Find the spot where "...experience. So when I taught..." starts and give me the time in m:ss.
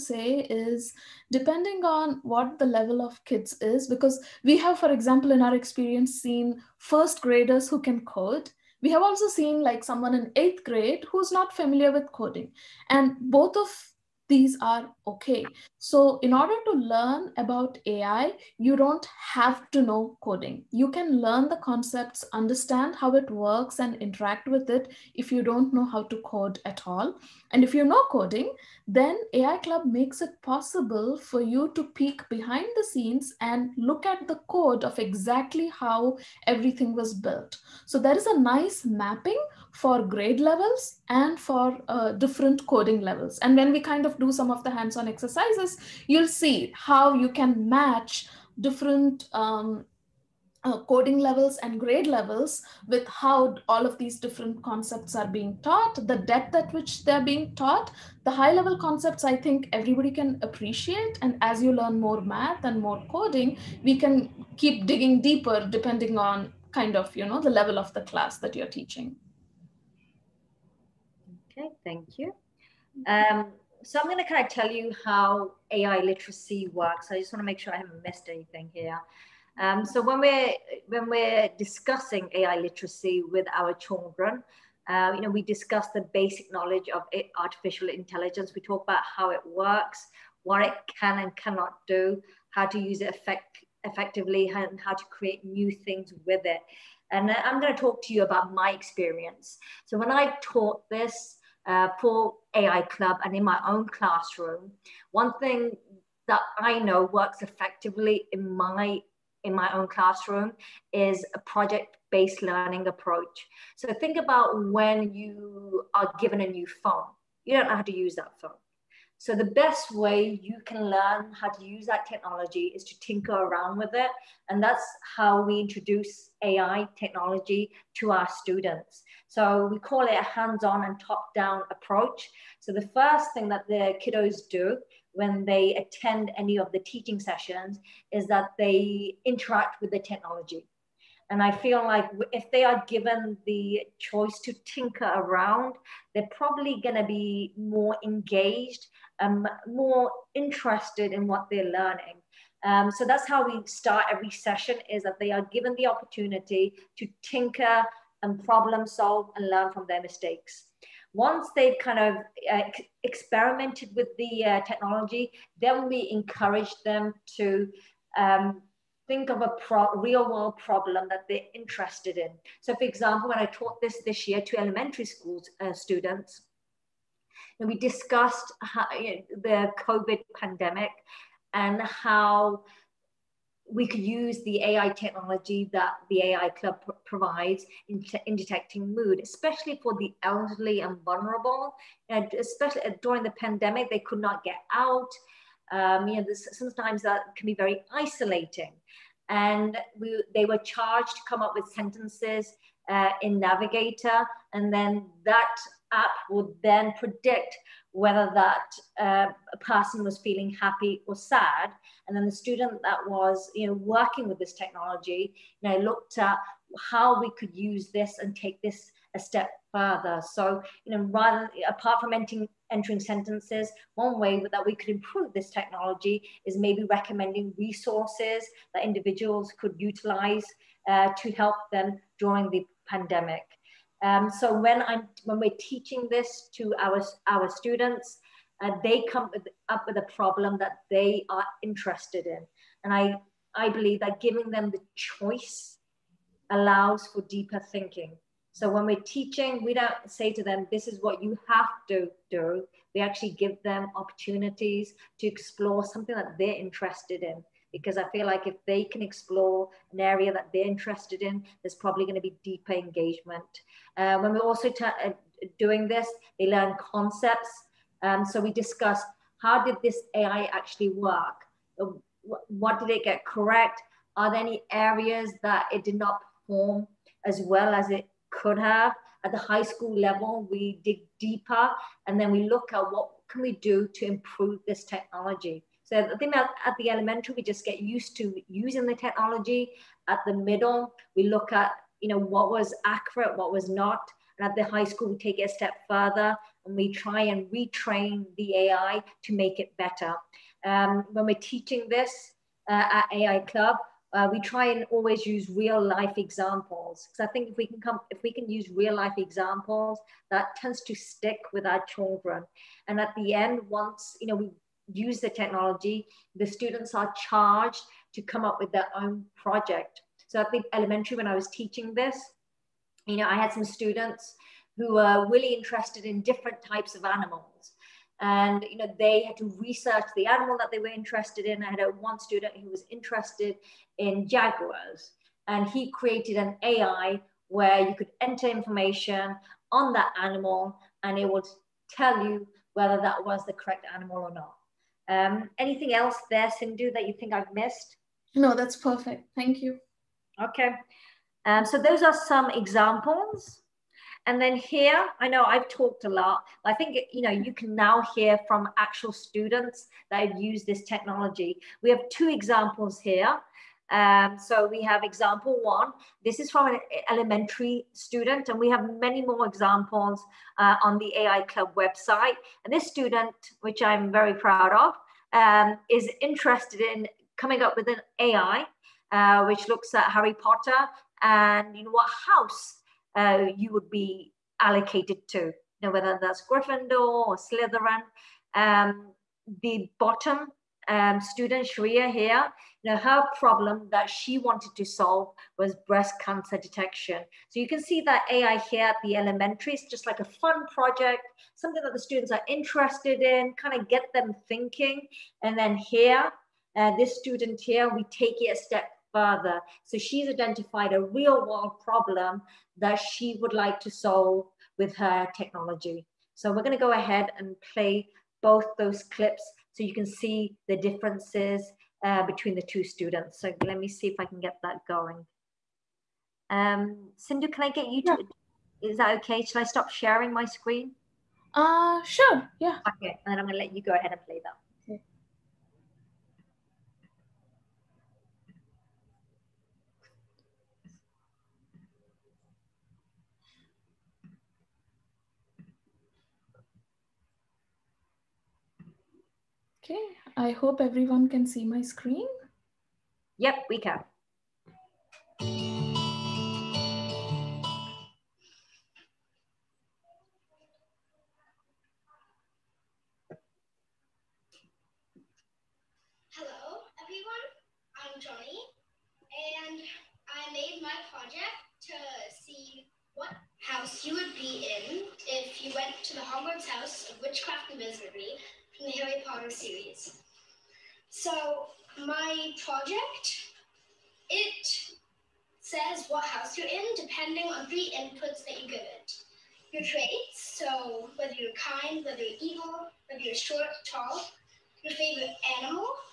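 1:38.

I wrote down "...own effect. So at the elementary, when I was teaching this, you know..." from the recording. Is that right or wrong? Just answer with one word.
wrong.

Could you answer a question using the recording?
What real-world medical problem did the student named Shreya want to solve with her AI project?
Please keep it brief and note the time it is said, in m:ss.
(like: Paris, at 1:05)
breast cancer detection, at 6:35.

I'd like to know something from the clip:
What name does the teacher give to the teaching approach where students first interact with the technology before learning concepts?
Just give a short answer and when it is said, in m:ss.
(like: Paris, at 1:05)
hands-on and top-down, at 2:10.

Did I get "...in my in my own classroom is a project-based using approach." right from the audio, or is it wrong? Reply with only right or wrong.
wrong.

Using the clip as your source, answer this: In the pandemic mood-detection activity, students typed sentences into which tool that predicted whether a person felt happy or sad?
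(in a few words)
Navigator.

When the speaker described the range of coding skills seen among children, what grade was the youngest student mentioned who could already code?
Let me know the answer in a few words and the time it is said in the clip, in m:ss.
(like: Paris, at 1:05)
first graders, at 0:06.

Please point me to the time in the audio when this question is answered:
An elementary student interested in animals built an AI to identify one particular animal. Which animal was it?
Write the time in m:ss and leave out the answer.
5:34.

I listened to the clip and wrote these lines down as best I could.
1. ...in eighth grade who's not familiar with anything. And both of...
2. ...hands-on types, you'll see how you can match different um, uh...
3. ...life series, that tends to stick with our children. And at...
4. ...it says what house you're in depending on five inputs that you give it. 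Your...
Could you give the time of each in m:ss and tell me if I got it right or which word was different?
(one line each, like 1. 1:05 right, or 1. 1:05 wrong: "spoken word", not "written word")
1. 0:10 wrong: "coding", not "anything"
2. 0:44 wrong: "exercises", not "types"
3. 5:08 wrong: "examples", not "series"
4. 8:04 wrong: "three", not "five".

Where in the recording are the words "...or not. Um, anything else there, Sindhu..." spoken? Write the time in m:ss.
5:44.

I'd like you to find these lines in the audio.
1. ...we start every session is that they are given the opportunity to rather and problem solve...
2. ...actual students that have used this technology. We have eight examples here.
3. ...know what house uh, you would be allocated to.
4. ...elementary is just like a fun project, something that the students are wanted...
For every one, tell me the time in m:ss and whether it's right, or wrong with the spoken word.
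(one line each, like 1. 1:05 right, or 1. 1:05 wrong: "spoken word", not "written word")
1. 2:33 wrong: "tinker", not "rather"
2. 5:58 wrong: "two", not "eight"
3. 6:21 right
4. 6:39 wrong: "interested", not "wanted".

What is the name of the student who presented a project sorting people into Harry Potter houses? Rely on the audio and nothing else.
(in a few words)
Johnny.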